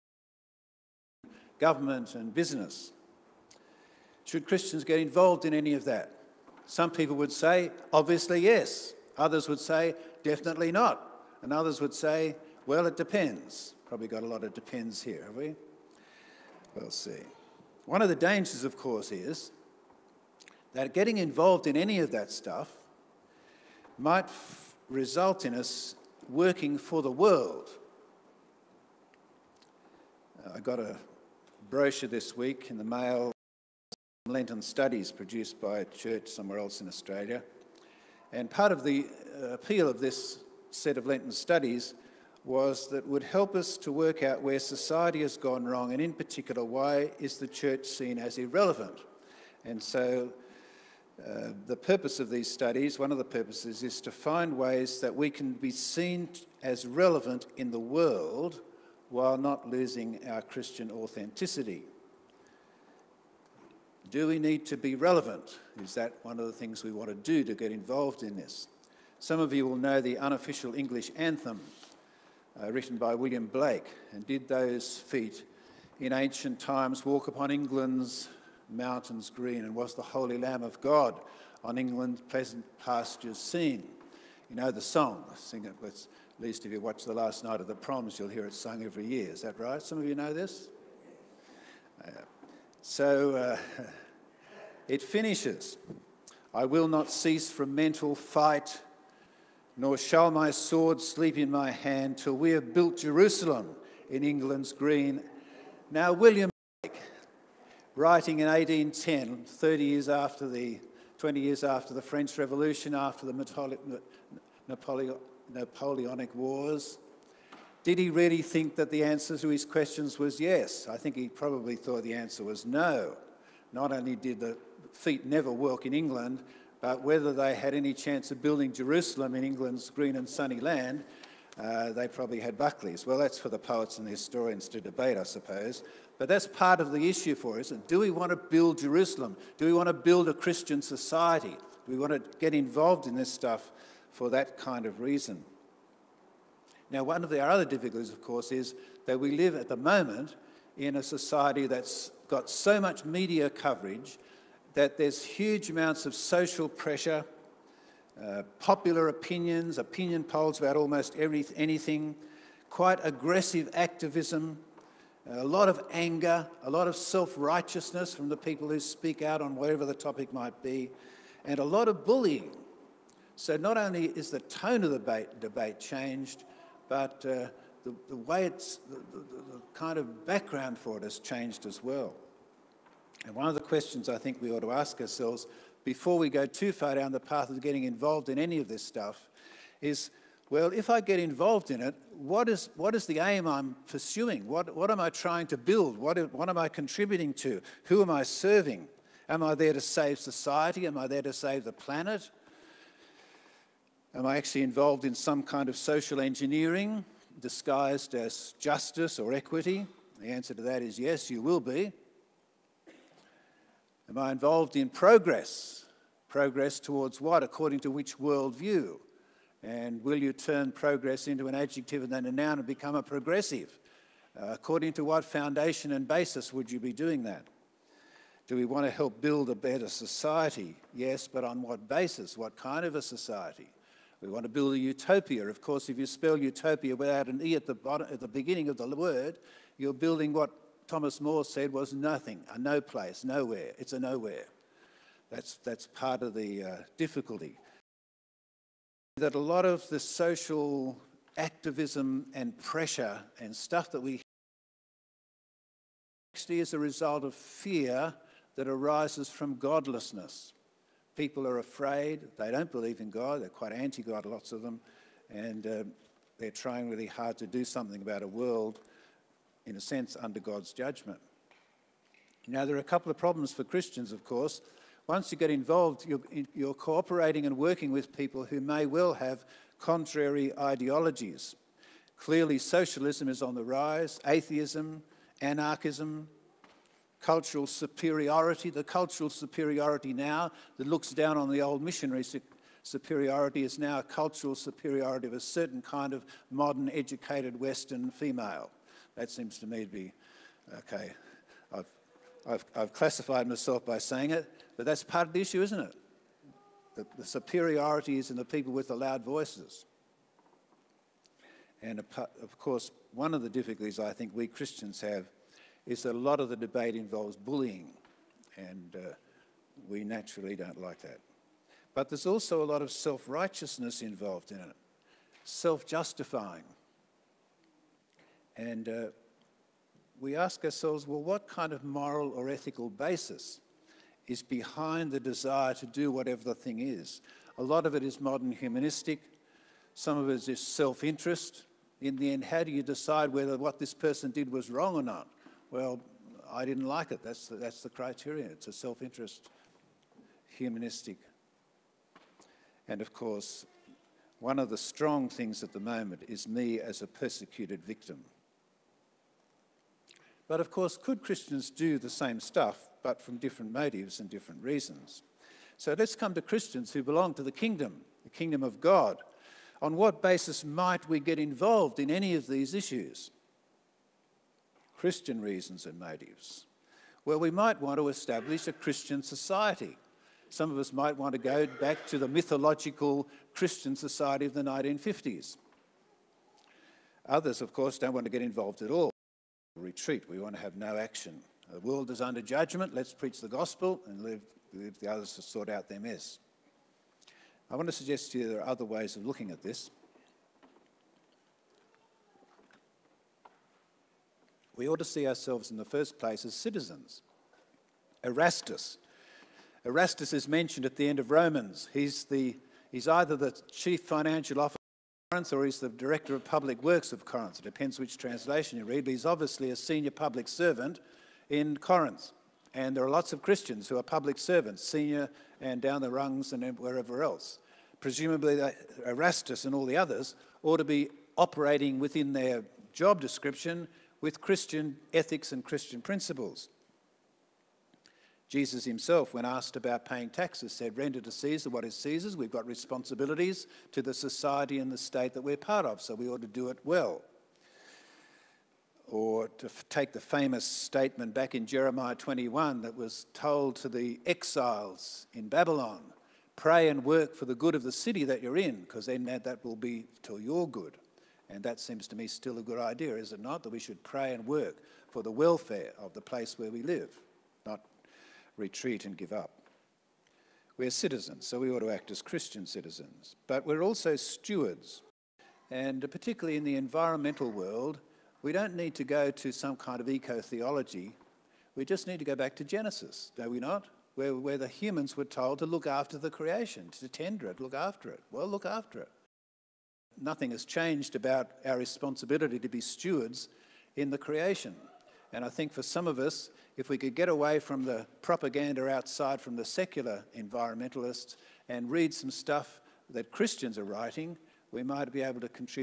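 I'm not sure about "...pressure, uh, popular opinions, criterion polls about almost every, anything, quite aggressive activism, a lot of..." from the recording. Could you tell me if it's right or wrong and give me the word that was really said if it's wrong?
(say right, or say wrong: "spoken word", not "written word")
wrong: "opinion", not "criterion".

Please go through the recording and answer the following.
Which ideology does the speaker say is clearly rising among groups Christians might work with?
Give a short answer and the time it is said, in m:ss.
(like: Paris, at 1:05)
socialism, at 4:42.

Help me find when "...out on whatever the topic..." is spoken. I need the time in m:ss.
2:49.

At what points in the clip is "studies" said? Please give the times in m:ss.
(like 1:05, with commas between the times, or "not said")
0:34, 0:41, 0:52.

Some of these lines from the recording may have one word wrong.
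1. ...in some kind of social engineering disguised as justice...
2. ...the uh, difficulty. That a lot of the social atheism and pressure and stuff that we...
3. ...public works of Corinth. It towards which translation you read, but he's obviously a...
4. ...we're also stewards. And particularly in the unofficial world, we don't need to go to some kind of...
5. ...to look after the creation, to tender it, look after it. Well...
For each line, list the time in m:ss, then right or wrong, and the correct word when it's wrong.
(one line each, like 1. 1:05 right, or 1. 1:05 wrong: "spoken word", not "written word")
1. 3:25 right
2. 4:06 wrong: "activism", not "atheism"
3. 6:56 wrong: "depends", not "towards"
4. 7:53 wrong: "environmental", not "unofficial"
5. 8:05 right.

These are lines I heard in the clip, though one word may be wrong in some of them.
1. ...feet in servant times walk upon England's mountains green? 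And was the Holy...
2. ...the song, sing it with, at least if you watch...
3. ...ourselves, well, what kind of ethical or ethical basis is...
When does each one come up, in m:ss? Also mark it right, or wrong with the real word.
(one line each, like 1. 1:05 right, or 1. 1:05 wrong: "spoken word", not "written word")
1. 1:14 wrong: "ancient", not "servant"
2. 1:24 right
3. 5:30 wrong: "moral", not "ethical".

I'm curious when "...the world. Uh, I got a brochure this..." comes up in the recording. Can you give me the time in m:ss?
0:27.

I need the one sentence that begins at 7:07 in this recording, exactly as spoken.
Presumably, Erastus and all the others ought to be operating within their job description with Christian ethics and Christian principles.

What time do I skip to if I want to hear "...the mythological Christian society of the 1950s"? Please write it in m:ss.
6:22.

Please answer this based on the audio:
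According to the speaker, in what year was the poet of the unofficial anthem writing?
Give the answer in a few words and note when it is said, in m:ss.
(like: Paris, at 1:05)
1810, at 1:48.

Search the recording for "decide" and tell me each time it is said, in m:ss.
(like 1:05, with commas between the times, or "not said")
5:42.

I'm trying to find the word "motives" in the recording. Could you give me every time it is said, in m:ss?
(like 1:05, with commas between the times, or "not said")
6:03, 6:15.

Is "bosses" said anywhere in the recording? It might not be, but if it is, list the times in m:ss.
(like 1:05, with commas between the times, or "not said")
not said.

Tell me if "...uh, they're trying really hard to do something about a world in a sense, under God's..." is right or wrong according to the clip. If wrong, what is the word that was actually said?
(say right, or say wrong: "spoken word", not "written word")
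right.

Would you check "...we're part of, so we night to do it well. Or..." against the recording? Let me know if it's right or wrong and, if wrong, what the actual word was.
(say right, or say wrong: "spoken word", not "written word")
wrong: "ought", not "night".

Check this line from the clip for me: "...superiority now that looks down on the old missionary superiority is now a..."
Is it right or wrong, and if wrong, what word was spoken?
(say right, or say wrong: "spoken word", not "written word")
right.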